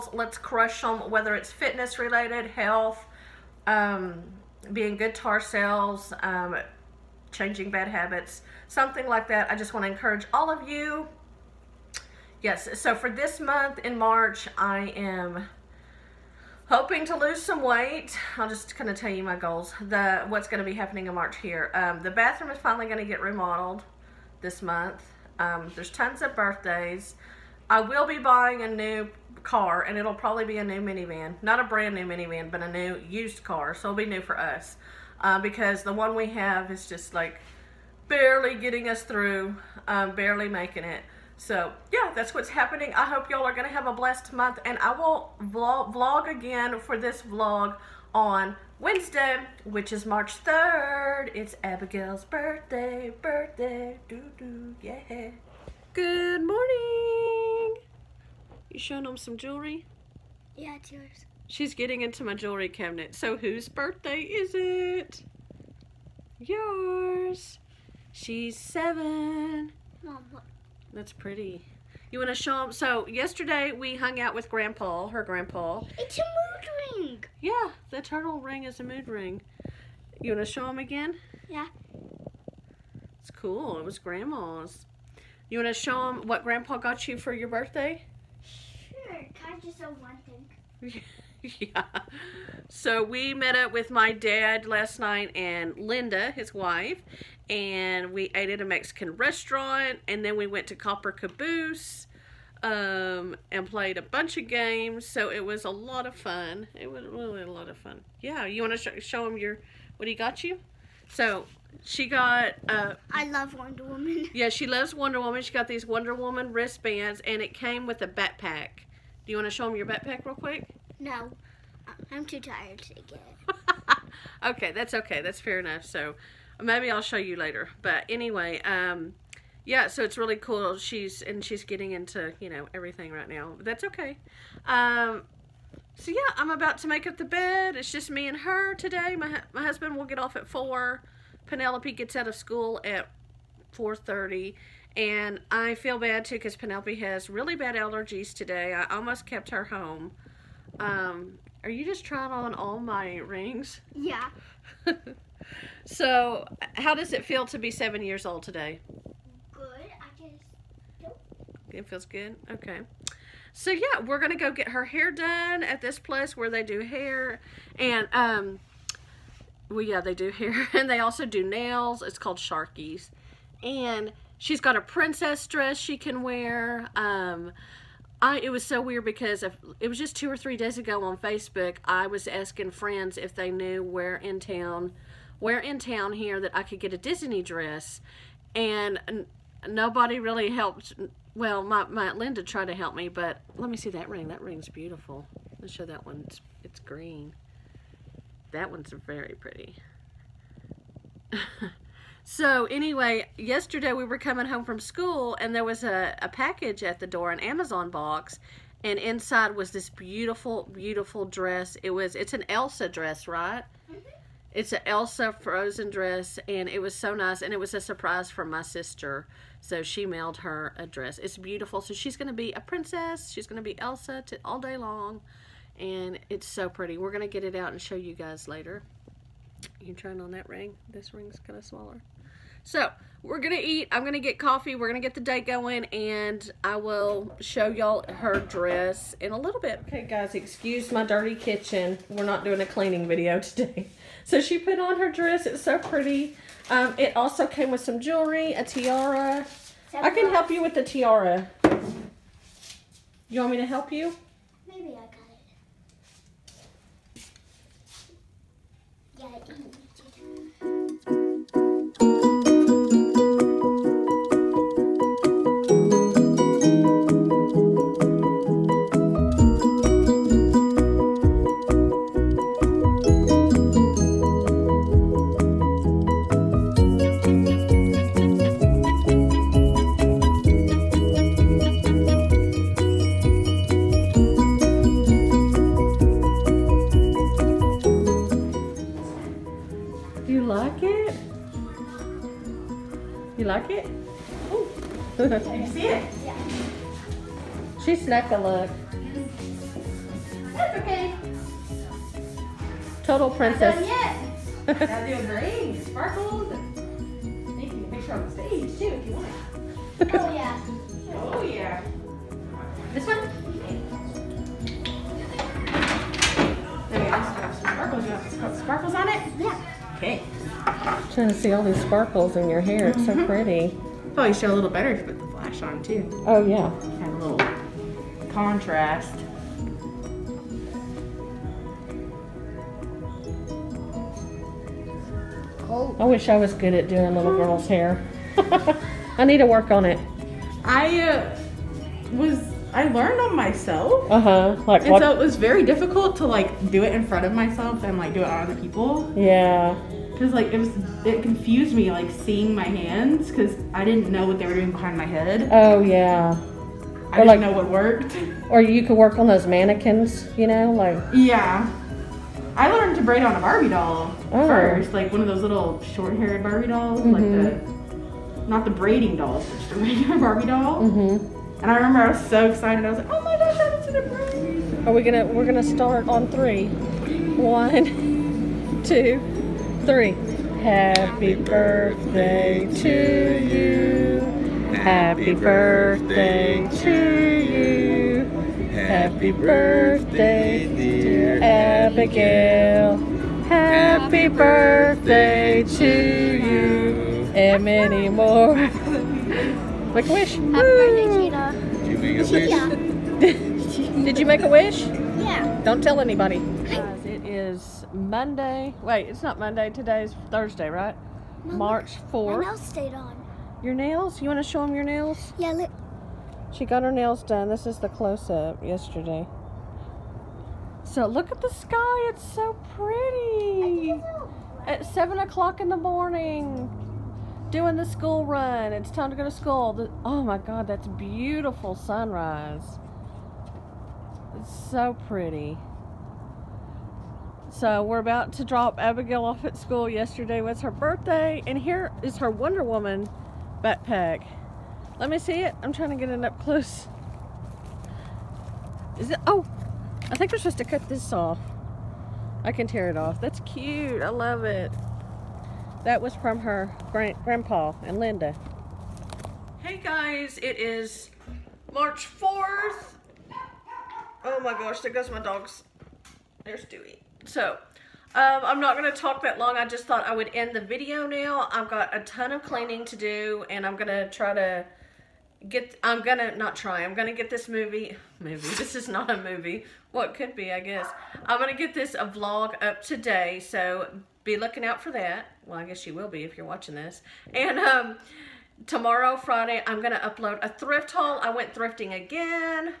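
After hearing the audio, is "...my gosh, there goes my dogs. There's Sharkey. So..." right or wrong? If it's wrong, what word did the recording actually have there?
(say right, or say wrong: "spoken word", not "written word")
wrong: "Dewey", not "Sharkey".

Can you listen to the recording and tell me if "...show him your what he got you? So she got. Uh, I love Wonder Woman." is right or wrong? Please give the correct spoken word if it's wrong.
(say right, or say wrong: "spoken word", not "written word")
right.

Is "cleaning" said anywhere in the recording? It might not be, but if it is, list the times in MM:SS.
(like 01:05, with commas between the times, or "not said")
04:02, 07:52.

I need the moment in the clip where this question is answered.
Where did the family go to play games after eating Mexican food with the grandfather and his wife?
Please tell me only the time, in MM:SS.
01:40.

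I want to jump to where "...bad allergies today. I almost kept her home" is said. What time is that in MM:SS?
02:27.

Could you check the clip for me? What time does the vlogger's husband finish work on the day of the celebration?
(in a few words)
4.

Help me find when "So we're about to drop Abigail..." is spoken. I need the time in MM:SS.
07:17.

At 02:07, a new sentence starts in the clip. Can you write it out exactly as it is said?
But anyway, um, yeah, so it's really cool.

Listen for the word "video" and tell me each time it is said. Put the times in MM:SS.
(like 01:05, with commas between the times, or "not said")
04:03, 07:50.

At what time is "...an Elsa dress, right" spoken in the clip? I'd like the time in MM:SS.
03:32.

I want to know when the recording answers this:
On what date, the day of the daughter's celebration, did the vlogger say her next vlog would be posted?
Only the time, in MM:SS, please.
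00:50.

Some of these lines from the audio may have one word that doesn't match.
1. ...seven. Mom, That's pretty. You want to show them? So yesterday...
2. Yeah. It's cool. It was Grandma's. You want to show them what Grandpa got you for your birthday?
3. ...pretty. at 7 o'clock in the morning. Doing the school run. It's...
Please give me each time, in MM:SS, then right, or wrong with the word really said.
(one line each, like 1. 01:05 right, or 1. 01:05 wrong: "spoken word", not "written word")
1. 01:08 right
2. 01:21 right
3. 07:02 right.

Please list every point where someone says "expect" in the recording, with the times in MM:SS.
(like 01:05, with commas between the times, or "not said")
not said.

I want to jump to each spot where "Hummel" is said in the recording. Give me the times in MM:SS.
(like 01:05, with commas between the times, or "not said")
not said.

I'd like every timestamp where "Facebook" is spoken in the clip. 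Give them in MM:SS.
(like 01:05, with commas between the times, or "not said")
03:01.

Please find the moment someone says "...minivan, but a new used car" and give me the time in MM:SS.
00:32.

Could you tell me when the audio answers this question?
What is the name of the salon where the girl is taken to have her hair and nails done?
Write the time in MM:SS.
02:52.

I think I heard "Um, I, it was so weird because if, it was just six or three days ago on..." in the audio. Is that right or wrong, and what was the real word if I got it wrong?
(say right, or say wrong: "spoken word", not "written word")
wrong: "two", not "six".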